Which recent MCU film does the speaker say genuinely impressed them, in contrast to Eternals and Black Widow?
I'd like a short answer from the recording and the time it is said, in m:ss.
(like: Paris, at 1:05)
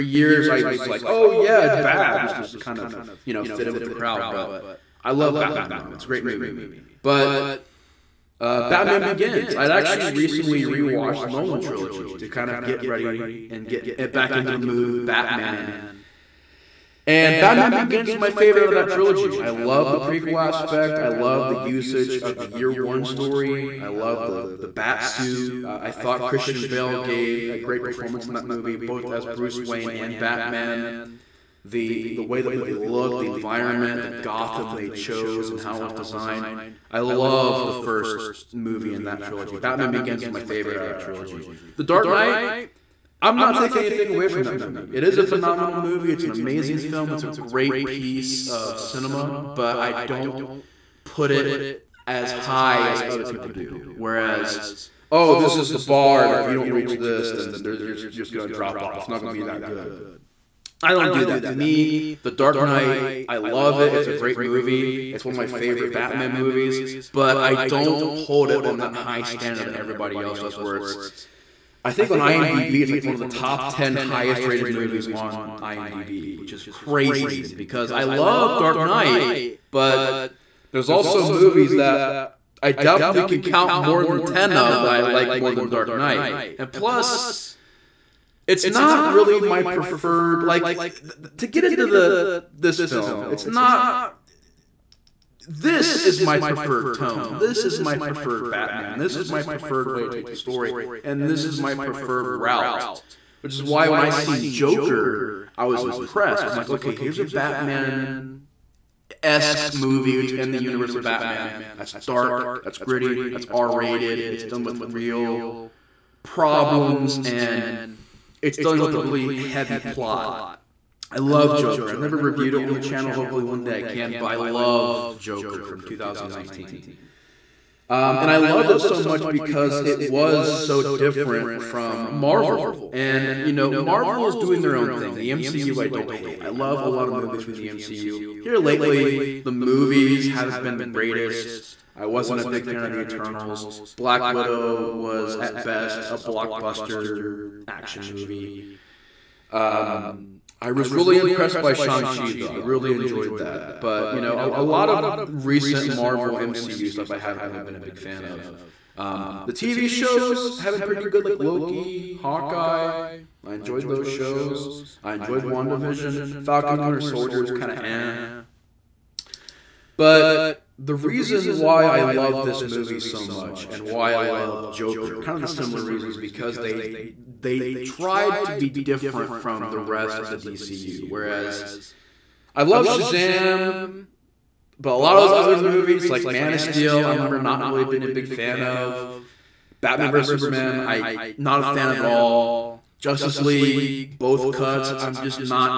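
Shang-Chi, at 2:31.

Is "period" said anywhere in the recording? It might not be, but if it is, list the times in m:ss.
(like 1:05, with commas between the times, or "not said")
not said.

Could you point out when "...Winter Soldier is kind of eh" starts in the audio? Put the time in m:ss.
2:46.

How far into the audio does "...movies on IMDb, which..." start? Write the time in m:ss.
1:14.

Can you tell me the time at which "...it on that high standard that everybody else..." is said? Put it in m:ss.
1:08.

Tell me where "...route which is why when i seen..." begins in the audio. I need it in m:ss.
1:42.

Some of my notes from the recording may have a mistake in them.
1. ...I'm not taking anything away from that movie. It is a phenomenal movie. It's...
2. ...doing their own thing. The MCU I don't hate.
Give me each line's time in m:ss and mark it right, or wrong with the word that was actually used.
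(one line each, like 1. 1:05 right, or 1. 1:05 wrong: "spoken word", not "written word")
1. 0:43 right
2. 2:14 right.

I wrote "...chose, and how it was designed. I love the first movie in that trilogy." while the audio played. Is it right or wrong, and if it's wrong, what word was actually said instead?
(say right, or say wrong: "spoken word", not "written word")
right.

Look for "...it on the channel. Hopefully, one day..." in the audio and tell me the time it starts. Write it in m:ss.
2:02.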